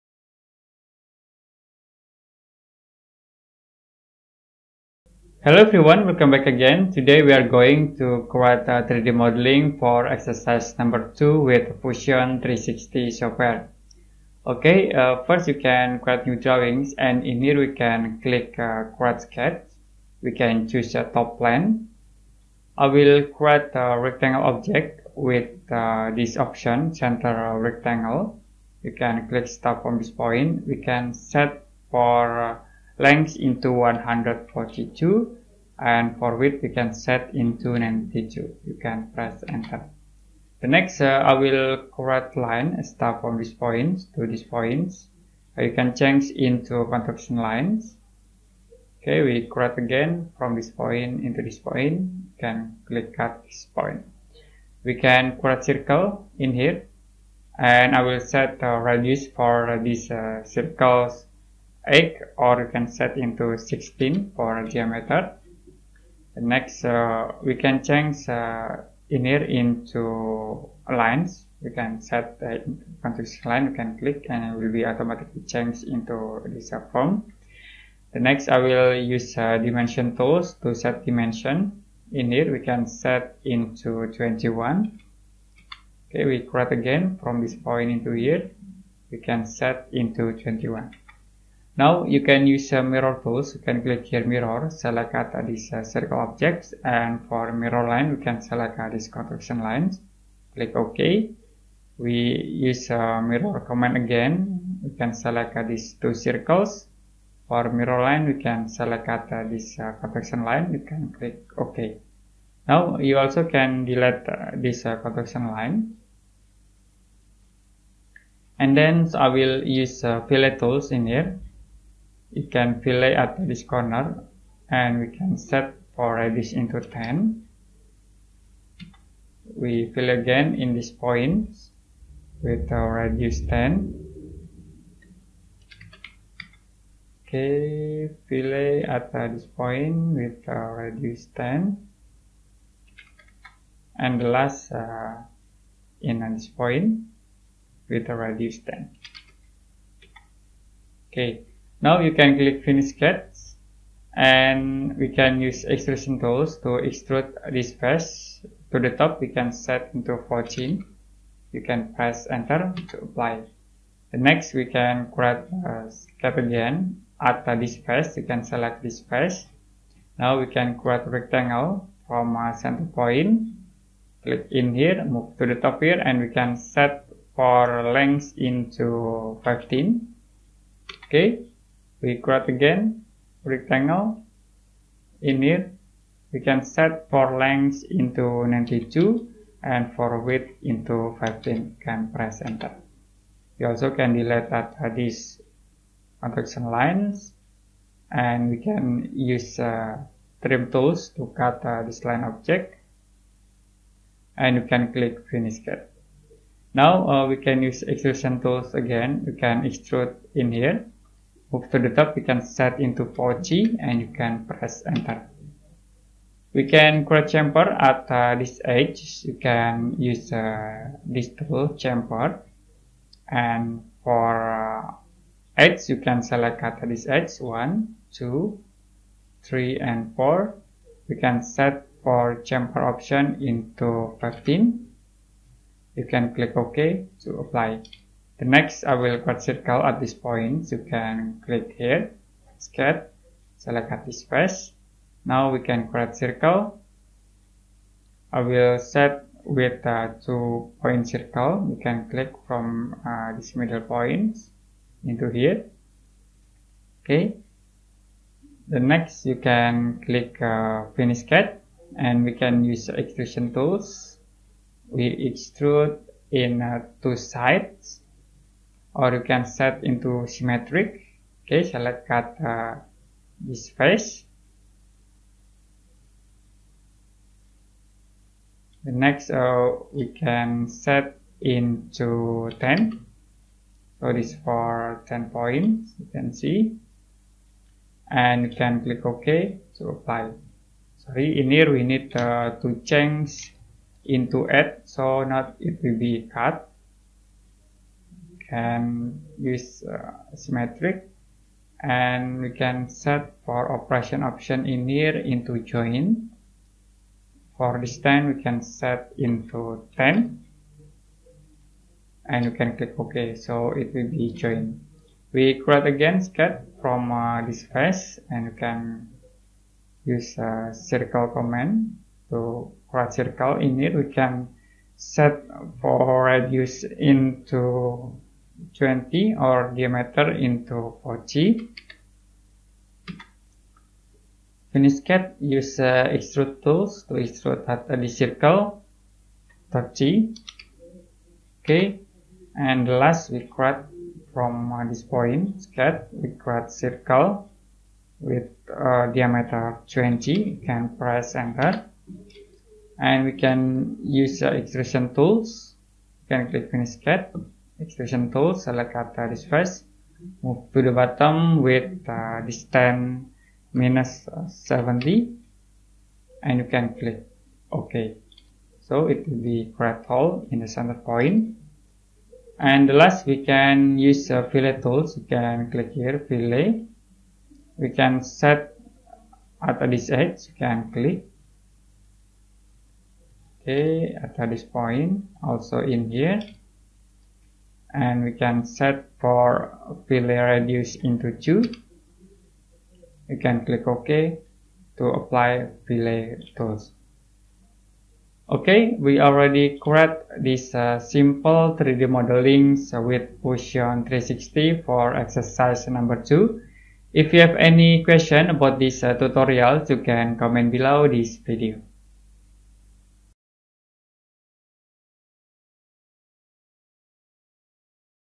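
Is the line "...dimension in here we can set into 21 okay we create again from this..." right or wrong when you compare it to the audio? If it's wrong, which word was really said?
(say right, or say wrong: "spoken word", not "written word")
right.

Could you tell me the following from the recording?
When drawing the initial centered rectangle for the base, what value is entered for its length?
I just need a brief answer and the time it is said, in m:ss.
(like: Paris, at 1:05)
142, at 0:33.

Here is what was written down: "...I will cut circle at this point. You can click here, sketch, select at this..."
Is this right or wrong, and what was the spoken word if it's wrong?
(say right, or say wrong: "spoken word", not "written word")
right.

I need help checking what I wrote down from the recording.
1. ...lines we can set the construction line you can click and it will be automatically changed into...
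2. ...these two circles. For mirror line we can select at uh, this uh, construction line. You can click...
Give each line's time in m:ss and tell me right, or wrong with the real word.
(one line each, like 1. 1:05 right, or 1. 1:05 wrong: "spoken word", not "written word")
1. 1:10 right
2. 1:45 right.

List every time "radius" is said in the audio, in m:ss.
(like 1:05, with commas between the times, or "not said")
0:58, 2:06, 2:12, 2:20, 2:28, 5:26, 6:30.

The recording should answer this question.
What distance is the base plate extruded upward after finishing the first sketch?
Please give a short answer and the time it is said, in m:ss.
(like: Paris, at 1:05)
14, at 2:40.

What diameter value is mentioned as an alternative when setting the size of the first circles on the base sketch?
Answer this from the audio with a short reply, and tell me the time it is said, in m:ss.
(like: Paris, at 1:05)
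16, at 1:03.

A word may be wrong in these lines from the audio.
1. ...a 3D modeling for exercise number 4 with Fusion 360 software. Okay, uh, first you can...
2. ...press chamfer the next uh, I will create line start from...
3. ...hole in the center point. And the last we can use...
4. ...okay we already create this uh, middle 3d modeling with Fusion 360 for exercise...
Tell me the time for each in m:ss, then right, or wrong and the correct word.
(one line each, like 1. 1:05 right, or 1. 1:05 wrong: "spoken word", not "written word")
1. 0:08 wrong: "2", not "4"
2. 0:39 wrong: "enter", not "chamfer"
3. 6:10 right
4. 6:38 wrong: "simple", not "middle".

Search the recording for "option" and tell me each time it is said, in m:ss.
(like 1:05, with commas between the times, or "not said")
0:26, 3:52, 5:04.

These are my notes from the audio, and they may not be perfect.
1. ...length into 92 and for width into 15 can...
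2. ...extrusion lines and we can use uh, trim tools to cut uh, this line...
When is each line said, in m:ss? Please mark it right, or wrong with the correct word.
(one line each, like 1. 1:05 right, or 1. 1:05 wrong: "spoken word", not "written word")
1. 3:07 right
2. 3:16 wrong: "construction", not "extrusion".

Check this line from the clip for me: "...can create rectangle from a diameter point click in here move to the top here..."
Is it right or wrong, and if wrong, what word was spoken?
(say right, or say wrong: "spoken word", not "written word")
wrong: "center", not "diameter".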